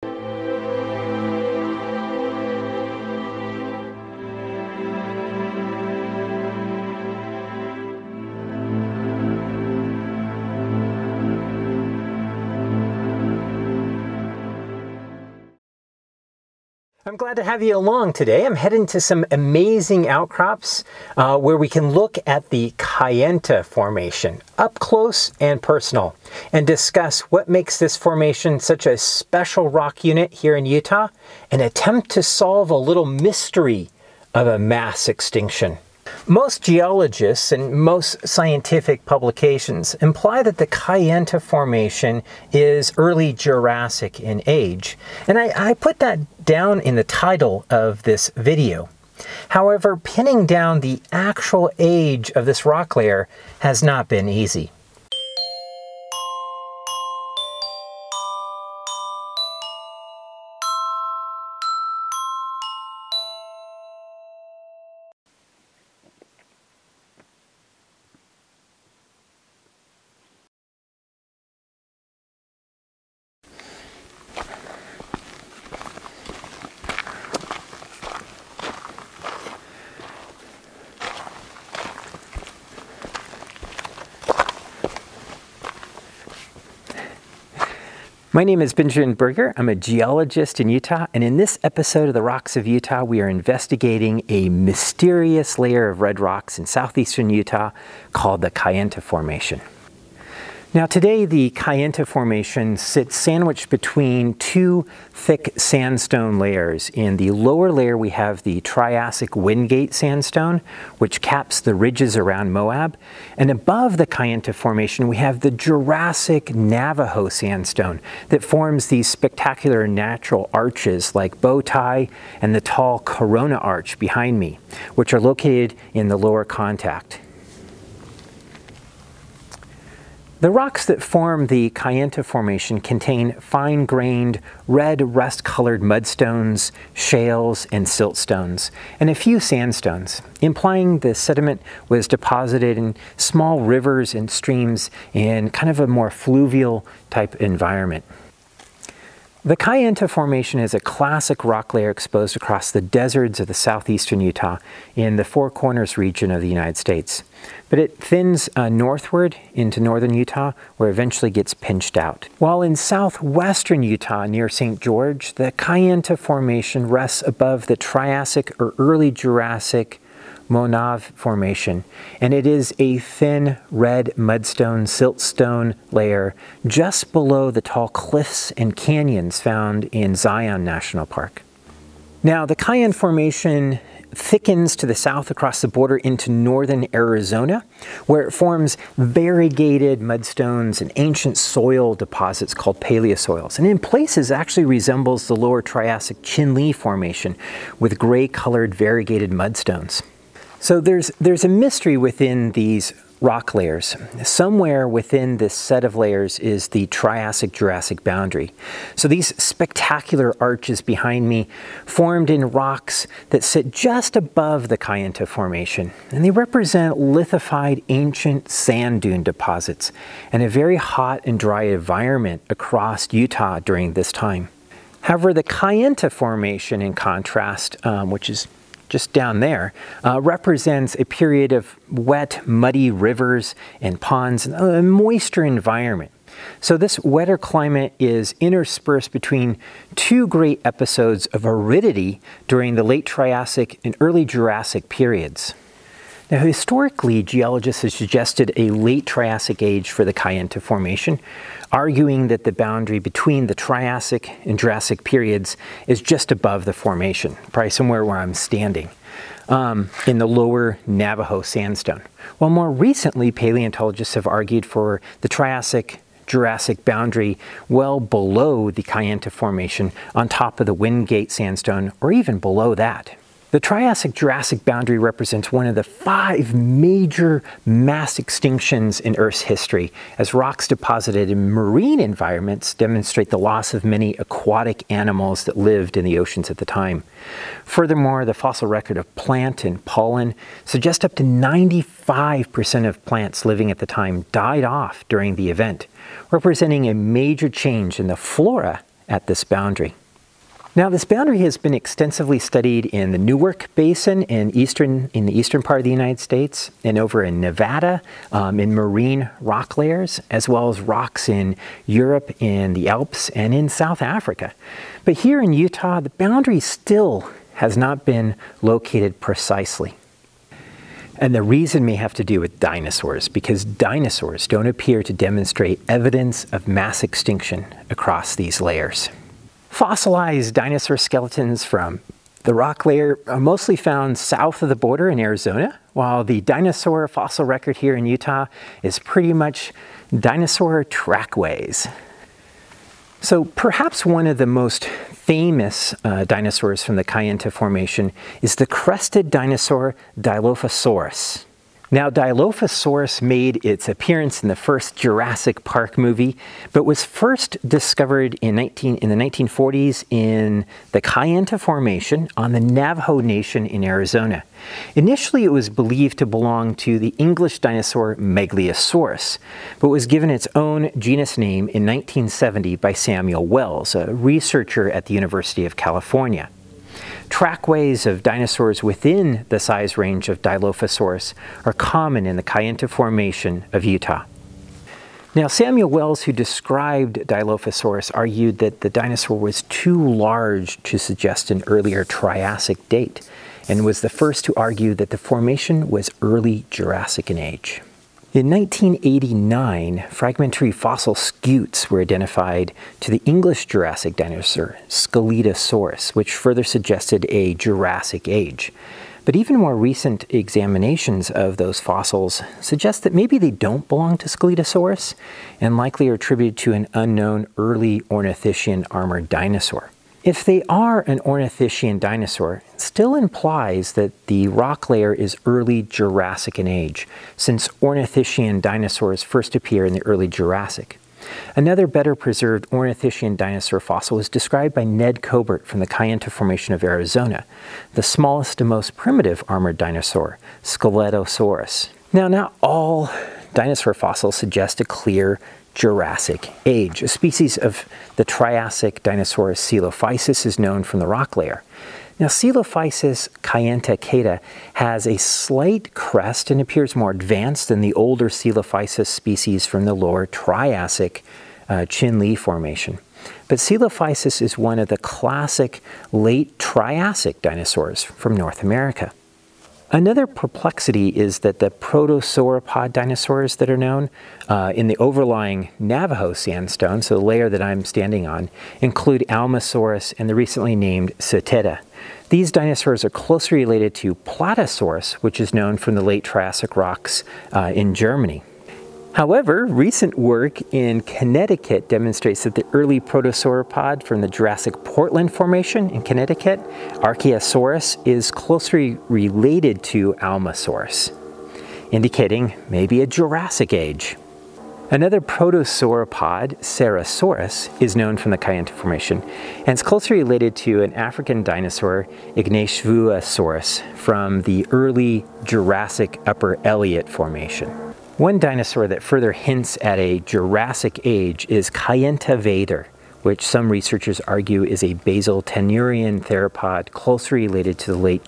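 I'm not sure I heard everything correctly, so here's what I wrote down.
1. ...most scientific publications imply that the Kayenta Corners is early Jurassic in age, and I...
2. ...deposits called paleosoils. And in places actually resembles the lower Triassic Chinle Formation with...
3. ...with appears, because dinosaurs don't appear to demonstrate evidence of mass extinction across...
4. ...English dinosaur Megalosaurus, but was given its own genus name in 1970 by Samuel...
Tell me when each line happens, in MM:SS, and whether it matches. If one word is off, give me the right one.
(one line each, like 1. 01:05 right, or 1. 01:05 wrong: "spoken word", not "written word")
1. 00:37 wrong: "Formation", not "Corners"
2. 03:11 right
3. 05:22 wrong: "dinosaurs", not "appears"
4. 06:07 right.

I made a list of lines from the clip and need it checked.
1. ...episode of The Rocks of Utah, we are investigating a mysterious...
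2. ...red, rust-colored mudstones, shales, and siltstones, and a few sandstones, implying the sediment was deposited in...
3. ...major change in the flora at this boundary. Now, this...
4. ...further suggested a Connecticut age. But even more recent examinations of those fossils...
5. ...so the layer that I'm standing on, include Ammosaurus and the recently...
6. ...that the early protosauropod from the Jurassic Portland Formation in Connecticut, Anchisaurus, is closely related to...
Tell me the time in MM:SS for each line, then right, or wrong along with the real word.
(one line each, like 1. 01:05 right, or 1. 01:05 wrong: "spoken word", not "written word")
1. 01:31 right
2. 02:14 right
3. 04:56 right
4. 06:46 wrong: "Jurassic", not "Connecticut"
5. 07:57 right
6. 08:12 right.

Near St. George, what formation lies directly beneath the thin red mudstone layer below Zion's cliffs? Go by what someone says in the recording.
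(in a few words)
Moenave Formation.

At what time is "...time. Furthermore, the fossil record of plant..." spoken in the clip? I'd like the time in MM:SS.
04:46.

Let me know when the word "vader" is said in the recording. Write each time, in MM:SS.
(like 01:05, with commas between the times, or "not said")
08:41.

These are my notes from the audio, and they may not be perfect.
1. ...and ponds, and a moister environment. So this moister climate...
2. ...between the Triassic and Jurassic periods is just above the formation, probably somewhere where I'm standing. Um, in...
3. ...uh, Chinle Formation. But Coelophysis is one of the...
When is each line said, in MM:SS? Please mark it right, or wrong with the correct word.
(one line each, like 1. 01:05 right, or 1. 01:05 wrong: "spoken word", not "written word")
1. 03:53 wrong: "wetter", not "moister"
2. 04:12 right
3. 07:41 right.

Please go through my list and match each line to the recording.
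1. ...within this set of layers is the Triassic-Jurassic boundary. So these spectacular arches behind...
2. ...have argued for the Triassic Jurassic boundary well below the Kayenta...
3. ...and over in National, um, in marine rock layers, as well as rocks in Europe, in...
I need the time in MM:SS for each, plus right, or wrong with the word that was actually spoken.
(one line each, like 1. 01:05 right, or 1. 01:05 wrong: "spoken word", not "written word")
1. 03:24 right
2. 04:24 right
3. 05:06 wrong: "Nevada", not "National".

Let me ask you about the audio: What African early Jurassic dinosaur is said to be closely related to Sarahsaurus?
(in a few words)
Ignavusaurus.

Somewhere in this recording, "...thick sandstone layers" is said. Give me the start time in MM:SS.
01:45.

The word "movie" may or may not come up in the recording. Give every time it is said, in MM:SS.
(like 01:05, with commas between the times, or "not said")
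05:55.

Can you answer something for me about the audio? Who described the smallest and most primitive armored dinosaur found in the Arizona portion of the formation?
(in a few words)
Ned Colbert.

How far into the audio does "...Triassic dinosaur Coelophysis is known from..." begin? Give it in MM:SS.
07:28.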